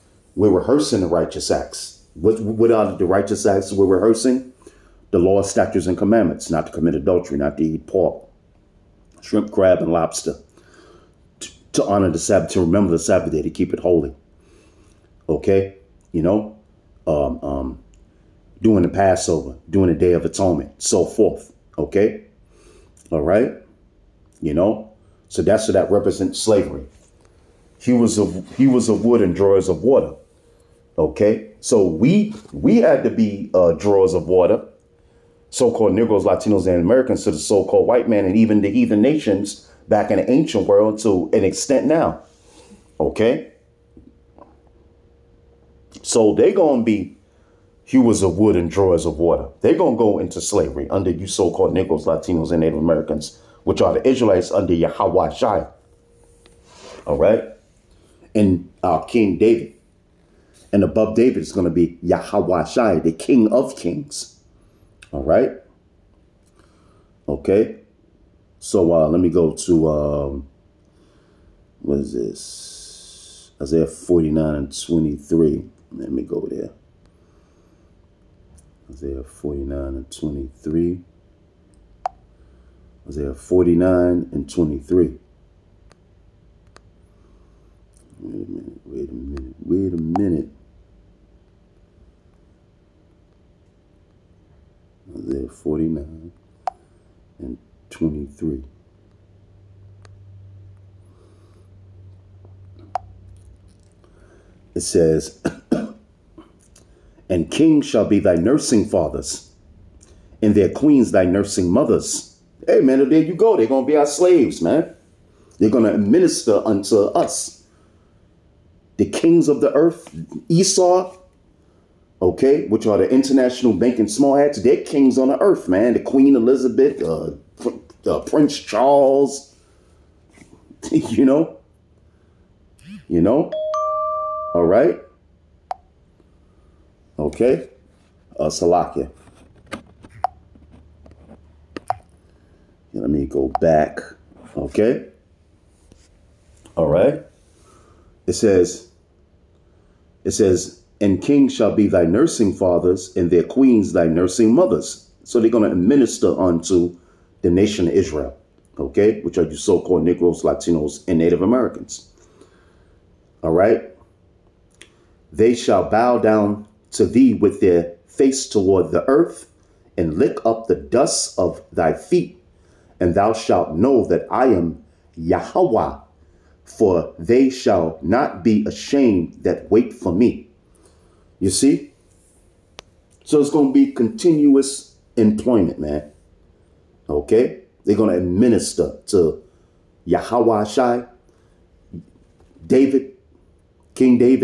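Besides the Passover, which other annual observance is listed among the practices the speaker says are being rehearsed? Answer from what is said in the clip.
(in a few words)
Day of Atonement.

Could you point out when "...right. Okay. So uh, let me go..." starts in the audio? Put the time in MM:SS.
01:05.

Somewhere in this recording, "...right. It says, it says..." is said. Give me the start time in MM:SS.
02:26.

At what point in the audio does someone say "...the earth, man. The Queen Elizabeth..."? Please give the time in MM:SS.
02:05.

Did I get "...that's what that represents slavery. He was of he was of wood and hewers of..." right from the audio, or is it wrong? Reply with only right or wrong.
wrong.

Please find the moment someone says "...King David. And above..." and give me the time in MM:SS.
00:59.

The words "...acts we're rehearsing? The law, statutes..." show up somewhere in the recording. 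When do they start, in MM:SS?
00:03.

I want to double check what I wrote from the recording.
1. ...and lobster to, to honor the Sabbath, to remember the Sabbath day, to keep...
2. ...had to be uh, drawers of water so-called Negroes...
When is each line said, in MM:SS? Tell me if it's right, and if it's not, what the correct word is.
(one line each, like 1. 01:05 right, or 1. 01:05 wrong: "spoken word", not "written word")
1. 00:09 right
2. 00:32 right.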